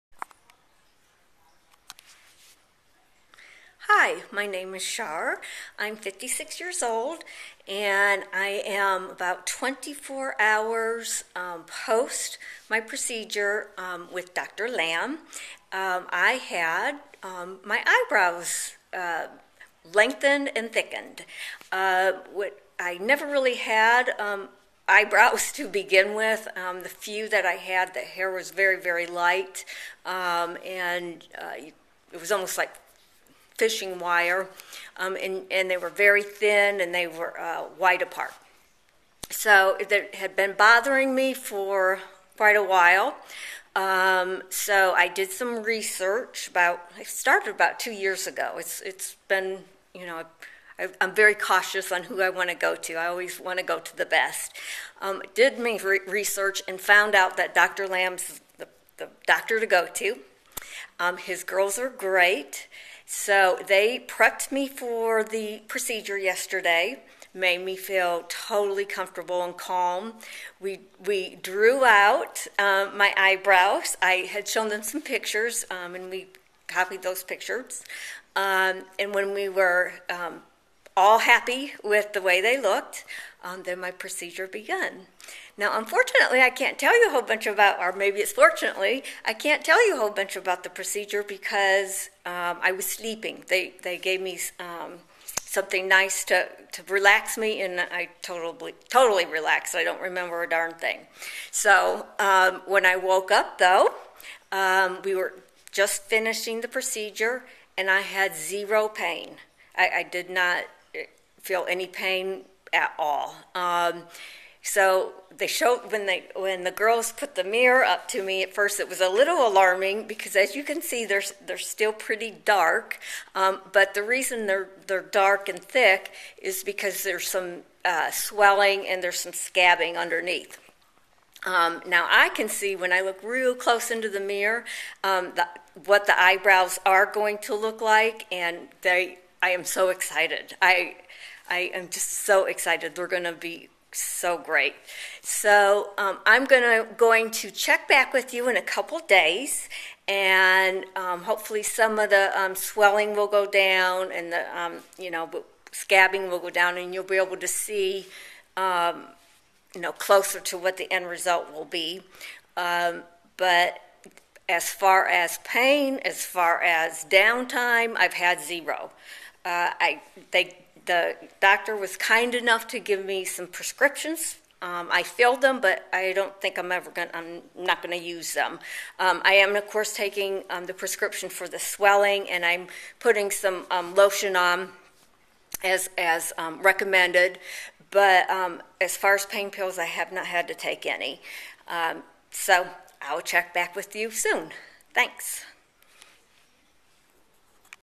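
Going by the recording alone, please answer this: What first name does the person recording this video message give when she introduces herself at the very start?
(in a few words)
Shar.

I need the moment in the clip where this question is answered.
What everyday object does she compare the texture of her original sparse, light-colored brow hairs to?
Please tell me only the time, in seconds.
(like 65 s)
33 s.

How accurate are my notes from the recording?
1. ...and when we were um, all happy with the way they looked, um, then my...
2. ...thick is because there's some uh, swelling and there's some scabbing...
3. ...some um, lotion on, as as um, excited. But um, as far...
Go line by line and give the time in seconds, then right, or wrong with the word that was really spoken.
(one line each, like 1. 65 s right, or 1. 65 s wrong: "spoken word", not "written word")
1. 78 s right
2. 125 s right
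3. 183 s wrong: "recommended", not "excited".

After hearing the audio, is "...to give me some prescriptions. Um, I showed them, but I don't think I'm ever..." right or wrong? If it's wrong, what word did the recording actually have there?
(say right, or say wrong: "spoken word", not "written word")
wrong: "filled", not "showed".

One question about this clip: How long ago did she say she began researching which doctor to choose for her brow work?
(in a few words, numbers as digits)
2 years ago.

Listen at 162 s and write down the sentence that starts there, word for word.
Um, but as far as pain, as far as downtime, I've had zero.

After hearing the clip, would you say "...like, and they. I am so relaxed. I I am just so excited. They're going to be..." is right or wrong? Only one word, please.
wrong.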